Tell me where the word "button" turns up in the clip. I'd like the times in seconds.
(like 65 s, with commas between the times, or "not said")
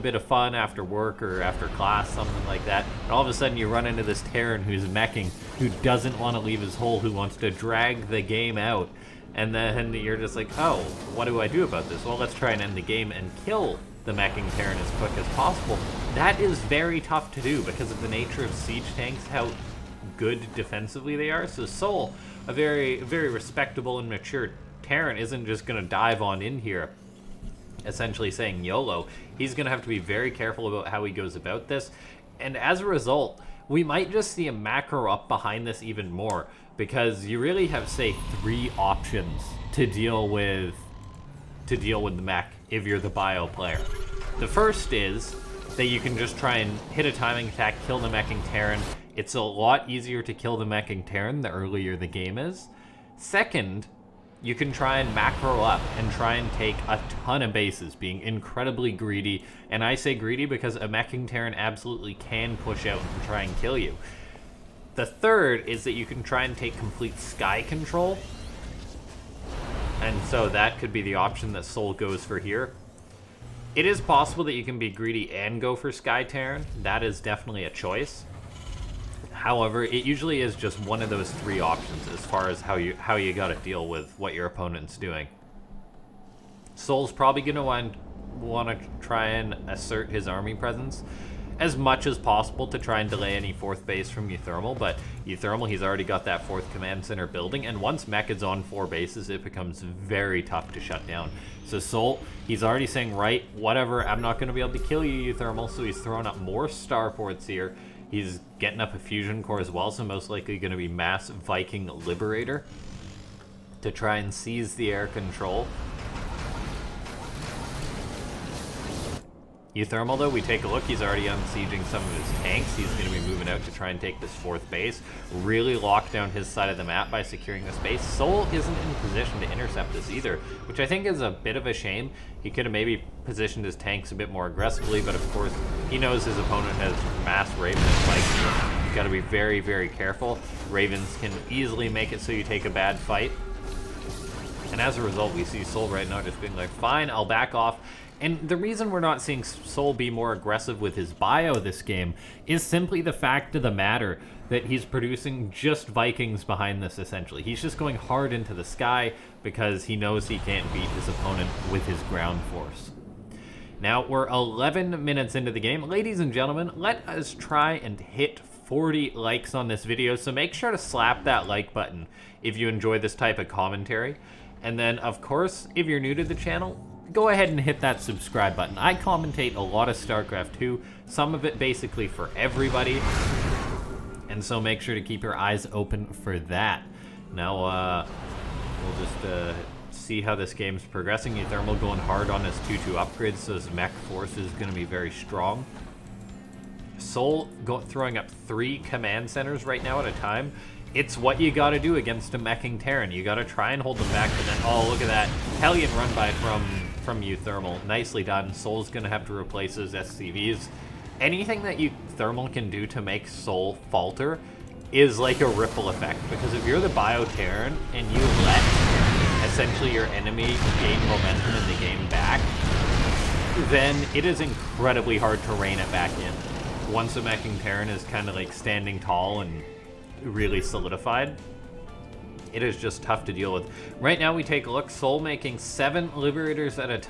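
171 s, 178 s.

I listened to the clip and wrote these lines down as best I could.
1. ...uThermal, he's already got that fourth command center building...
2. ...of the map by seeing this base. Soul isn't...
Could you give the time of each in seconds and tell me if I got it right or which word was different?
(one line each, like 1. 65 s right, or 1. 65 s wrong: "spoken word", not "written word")
1. 95 s right
2. 126 s wrong: "securing", not "seeing".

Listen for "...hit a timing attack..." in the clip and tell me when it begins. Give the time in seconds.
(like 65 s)
46 s.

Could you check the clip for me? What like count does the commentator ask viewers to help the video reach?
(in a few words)
40.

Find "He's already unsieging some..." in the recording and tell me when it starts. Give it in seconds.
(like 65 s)
120 s.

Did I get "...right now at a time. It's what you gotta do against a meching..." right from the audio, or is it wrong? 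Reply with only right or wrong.
right.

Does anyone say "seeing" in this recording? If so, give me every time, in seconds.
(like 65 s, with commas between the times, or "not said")
149 s.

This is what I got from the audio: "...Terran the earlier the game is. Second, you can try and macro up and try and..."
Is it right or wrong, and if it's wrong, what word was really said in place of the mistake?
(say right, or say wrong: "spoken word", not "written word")
right.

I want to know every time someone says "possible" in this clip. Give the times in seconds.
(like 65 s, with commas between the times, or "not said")
15 s, 73 s, 92 s.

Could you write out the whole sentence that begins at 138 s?
You've got to be very, very careful.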